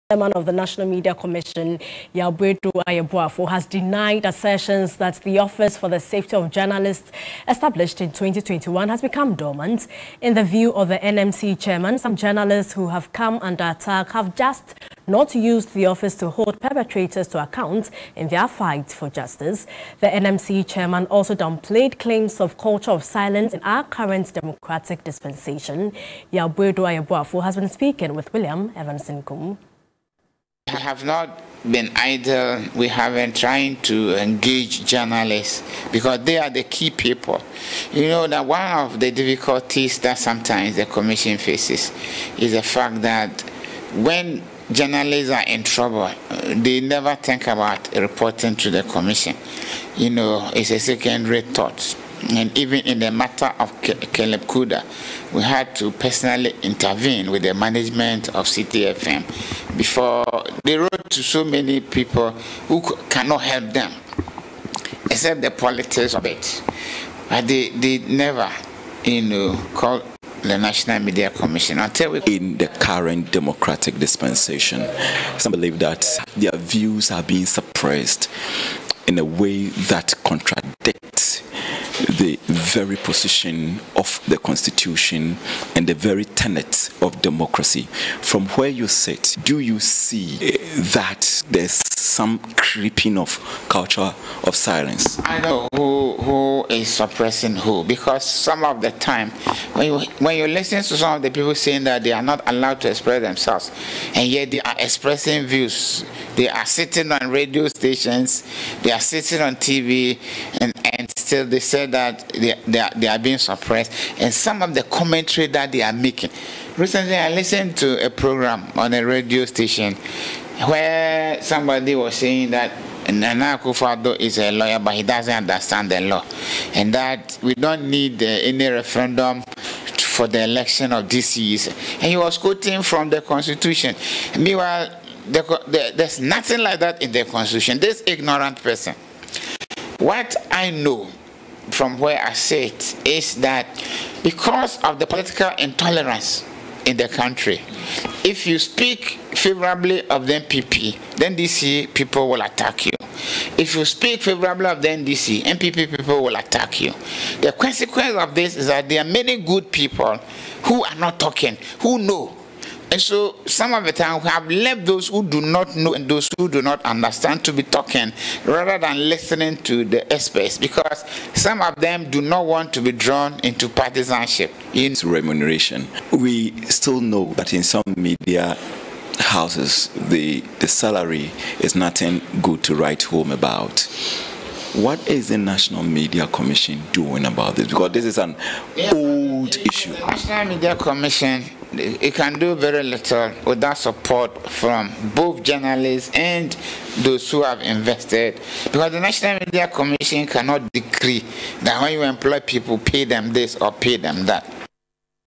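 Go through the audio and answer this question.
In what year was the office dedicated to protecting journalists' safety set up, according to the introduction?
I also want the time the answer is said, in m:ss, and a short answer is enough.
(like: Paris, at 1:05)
2021, at 0:08.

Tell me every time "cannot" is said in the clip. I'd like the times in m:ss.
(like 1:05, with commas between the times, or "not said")
1:03, 3:20.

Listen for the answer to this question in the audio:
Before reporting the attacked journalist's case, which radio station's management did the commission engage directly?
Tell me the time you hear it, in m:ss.
0:58.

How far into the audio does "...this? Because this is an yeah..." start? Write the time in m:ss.
3:07.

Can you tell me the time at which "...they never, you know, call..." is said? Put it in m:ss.
1:07.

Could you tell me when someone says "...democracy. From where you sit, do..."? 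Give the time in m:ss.
1:27.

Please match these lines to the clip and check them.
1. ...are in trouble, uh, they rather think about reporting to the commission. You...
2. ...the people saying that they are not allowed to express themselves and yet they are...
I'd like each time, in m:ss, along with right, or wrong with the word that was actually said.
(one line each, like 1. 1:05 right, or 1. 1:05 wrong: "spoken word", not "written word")
1. 0:45 wrong: "never", not "rather"
2. 1:41 right.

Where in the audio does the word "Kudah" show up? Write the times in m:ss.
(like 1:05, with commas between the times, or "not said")
0:54.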